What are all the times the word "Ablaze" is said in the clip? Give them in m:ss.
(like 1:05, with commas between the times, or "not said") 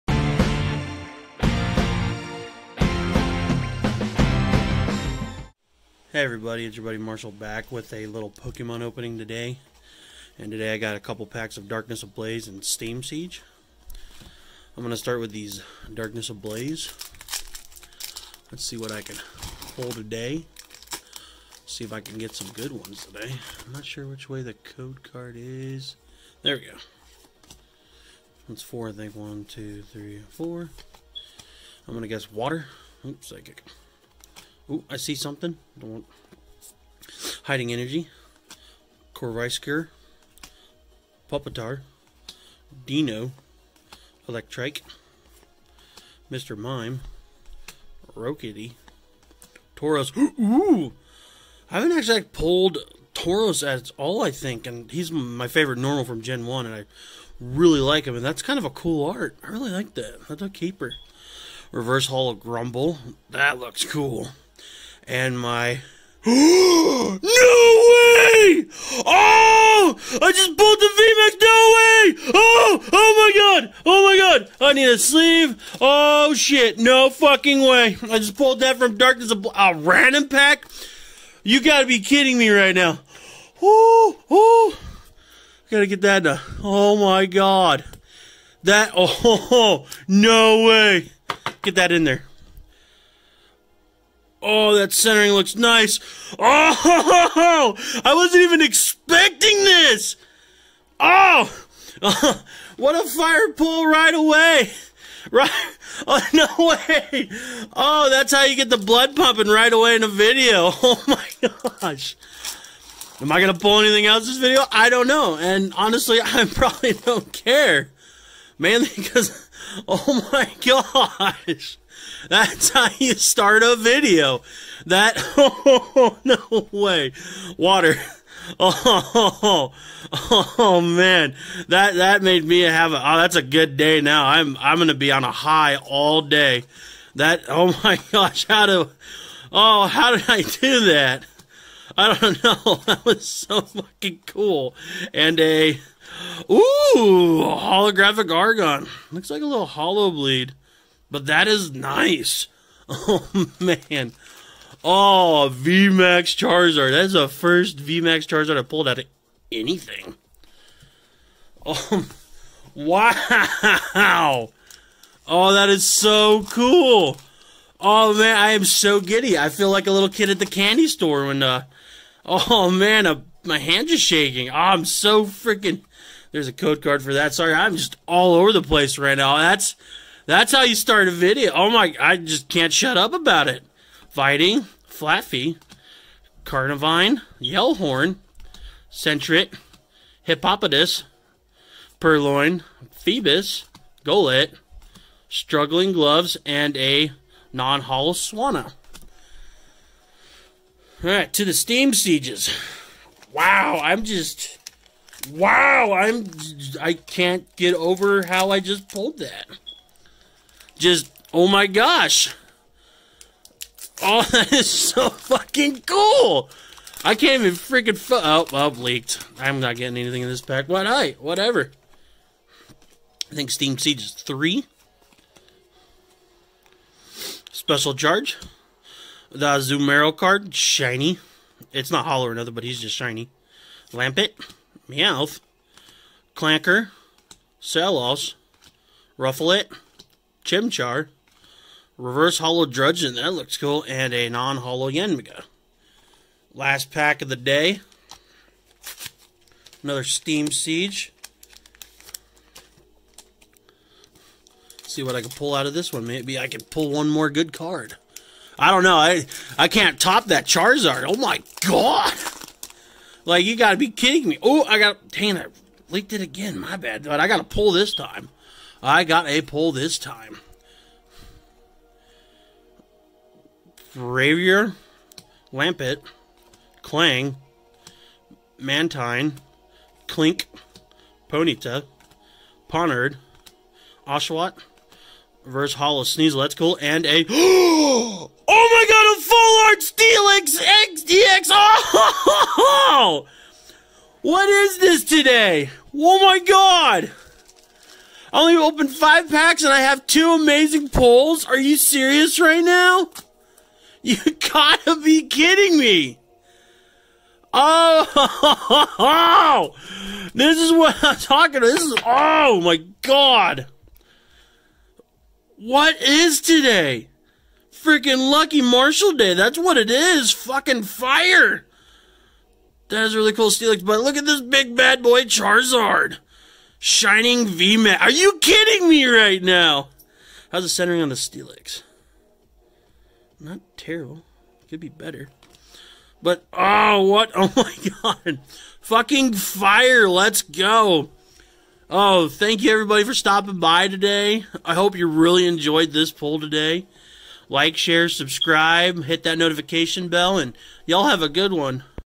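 0:12, 0:16.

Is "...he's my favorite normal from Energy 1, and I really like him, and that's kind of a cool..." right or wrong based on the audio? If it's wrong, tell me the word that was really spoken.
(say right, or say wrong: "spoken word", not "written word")
wrong: "Gen", not "Energy".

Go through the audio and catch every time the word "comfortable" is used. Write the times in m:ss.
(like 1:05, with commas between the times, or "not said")
not said.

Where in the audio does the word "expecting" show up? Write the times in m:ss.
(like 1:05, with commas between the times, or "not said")
1:38.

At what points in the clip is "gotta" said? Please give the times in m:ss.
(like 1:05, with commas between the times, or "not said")
1:21, 1:25, 4:23, 5:04.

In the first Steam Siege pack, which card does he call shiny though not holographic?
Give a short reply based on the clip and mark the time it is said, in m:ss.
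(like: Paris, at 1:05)
Zumero, at 3:49.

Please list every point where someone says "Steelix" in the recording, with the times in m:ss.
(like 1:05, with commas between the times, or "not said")
4:49, 5:23, 5:31.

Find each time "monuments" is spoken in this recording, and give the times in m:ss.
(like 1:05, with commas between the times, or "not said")
not said.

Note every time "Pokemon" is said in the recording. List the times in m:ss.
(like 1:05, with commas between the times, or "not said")
0:08.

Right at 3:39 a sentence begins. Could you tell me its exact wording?
I'm not getting anything in this pack.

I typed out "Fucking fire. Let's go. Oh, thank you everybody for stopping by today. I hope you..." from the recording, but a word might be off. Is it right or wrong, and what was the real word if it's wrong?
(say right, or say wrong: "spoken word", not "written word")
right.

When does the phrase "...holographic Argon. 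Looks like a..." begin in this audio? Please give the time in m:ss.
2:27.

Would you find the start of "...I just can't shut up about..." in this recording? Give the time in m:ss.
3:01.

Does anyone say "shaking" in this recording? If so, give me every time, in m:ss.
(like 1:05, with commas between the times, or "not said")
2:54.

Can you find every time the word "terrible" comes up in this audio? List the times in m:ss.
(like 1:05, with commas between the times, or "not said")
5:33.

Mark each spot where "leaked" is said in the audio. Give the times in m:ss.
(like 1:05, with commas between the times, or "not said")
3:38, 4:25.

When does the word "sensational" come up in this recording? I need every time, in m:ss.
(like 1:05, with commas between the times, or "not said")
not said.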